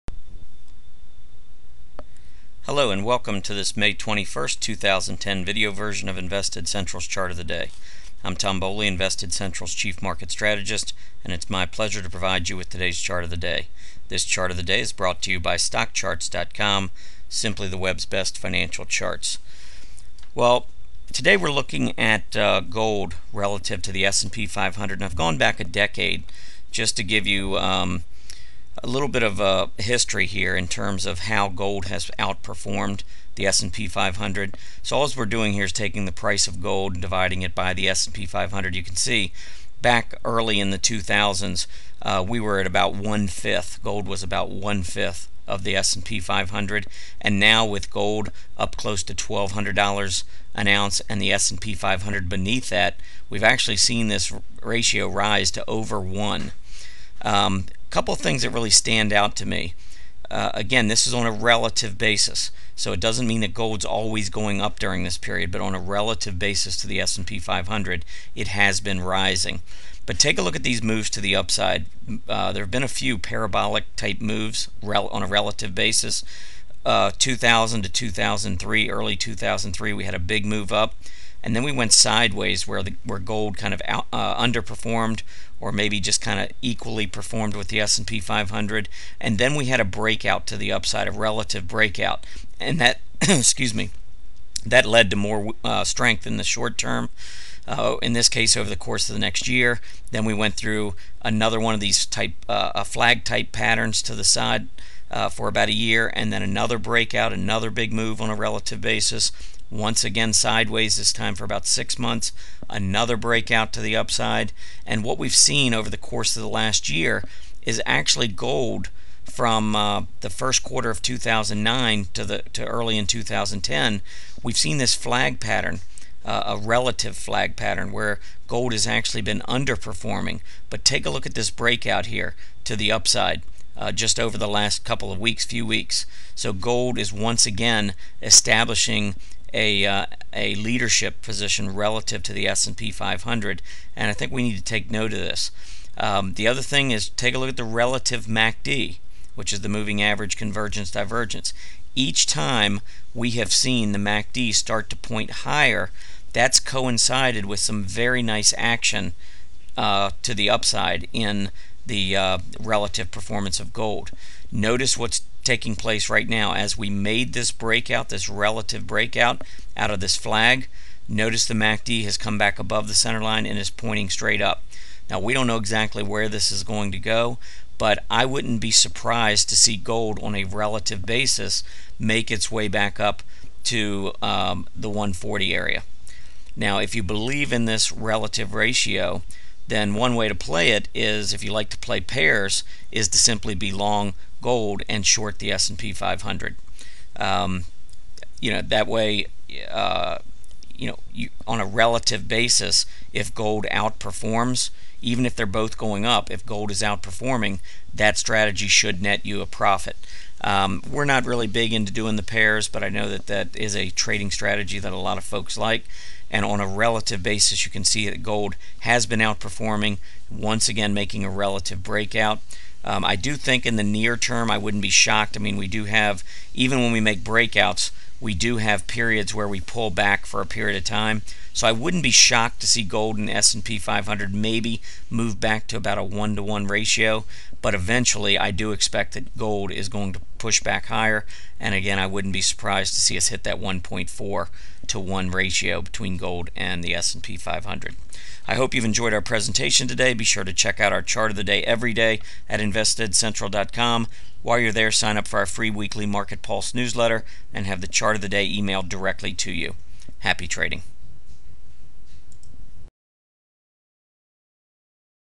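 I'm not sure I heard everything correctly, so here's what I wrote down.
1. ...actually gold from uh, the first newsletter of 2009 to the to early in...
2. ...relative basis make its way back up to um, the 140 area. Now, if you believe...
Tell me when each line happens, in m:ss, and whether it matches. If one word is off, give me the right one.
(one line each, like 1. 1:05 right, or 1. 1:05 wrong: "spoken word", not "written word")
1. 1:57 wrong: "quarter", not "newsletter"
2. 3:00 right.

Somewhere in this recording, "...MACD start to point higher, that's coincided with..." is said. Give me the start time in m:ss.
2:33.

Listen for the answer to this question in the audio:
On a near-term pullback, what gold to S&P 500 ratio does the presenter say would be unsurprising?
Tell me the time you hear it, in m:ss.
3:56.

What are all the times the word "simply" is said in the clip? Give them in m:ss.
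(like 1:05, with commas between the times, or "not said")
0:17, 3:13.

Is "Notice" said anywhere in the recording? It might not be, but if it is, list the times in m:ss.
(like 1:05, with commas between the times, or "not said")
2:44, 2:51.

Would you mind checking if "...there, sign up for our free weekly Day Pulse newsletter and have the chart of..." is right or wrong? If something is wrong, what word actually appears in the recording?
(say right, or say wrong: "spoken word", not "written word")
wrong: "Market", not "Day".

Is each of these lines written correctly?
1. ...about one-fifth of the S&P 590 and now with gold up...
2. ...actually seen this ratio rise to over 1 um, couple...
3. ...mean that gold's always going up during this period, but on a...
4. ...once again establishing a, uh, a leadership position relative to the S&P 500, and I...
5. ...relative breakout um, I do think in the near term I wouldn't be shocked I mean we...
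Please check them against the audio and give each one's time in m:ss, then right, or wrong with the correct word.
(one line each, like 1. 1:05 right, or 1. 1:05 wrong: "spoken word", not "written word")
1. 0:44 wrong: "500", not "590"
2. 0:53 right
3. 1:03 right
4. 2:17 right
5. 3:41 right.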